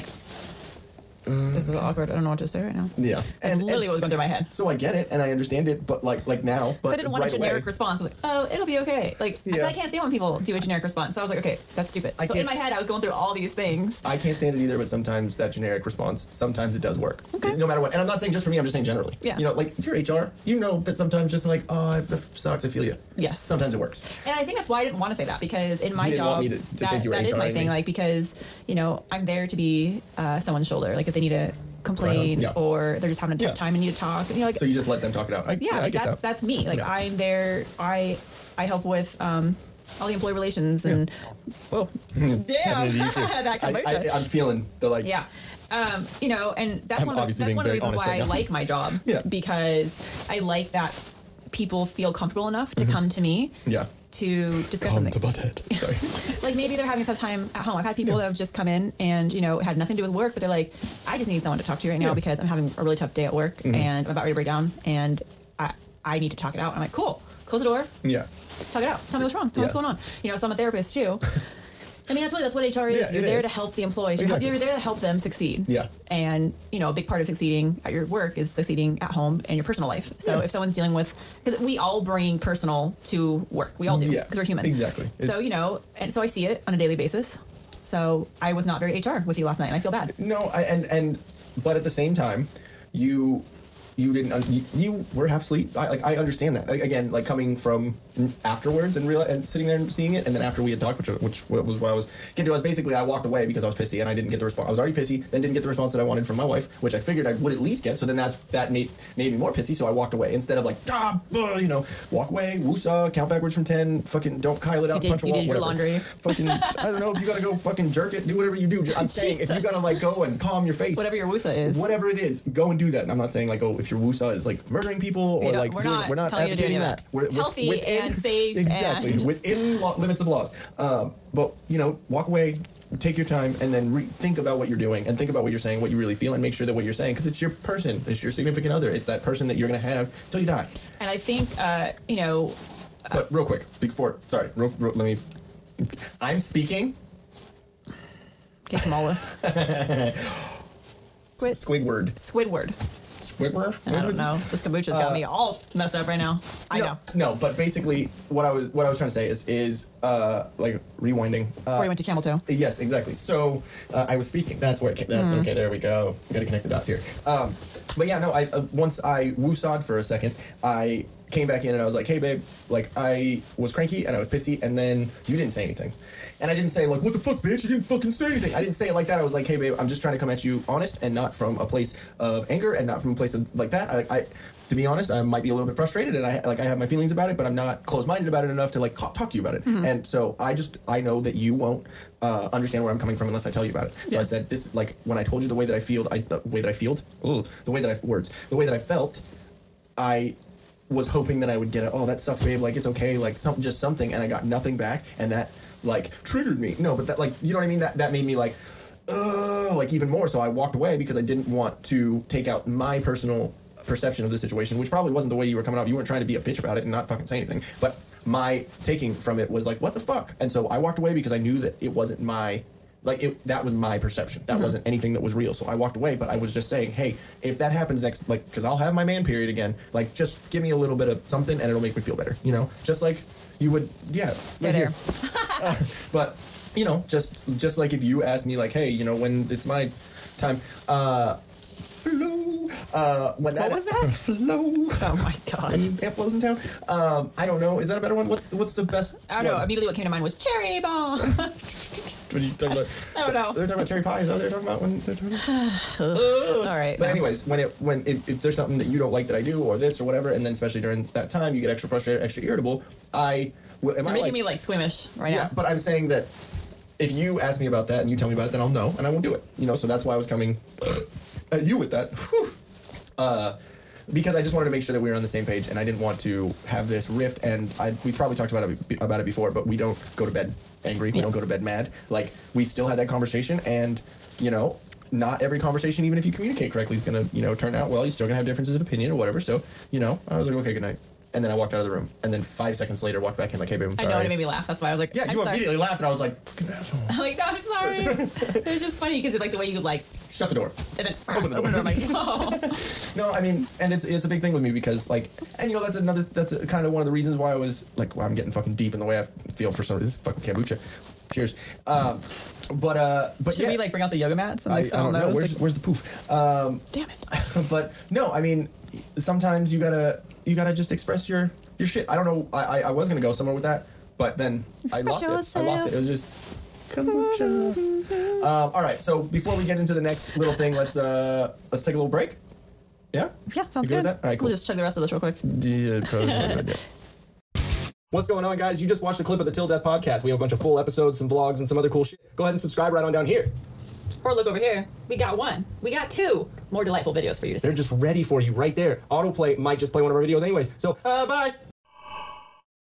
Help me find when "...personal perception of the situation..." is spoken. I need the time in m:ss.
3:33.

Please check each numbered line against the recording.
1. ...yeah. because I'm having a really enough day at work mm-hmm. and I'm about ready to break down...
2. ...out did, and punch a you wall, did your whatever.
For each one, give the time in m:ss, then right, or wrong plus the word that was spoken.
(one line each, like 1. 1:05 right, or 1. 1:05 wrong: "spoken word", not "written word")
1. 1:02 wrong: "tough", not "enough"
2. 1:54 right.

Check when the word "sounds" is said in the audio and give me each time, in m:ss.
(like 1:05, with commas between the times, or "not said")
5:33.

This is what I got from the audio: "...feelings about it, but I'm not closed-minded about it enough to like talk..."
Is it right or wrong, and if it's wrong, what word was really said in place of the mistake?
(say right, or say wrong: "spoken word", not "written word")
right.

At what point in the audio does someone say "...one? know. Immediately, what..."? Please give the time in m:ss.
4:09.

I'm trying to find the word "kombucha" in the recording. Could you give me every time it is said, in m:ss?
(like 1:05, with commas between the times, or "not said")
0:43, 2:34, 5:10, 5:26.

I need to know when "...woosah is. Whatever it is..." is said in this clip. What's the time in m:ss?
2:01.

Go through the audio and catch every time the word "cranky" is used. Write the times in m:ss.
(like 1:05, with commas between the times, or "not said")
2:53.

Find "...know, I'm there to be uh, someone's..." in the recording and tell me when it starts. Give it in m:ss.
0:28.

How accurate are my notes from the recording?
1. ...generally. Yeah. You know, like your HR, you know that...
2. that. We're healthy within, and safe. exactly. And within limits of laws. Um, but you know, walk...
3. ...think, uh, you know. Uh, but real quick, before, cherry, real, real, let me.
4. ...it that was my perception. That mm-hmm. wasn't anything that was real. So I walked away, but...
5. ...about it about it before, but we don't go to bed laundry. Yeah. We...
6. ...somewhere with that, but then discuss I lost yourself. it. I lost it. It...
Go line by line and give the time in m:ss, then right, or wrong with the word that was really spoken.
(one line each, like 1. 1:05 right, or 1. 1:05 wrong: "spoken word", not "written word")
1. 0:18 right
2. 2:06 right
3. 2:21 wrong: "sorry", not "cherry"
4. 3:43 right
5. 4:38 wrong: "angry", not "laundry"
6. 5:23 wrong: "express", not "discuss".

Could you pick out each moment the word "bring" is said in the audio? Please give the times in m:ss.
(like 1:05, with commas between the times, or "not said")
1:22, 5:13.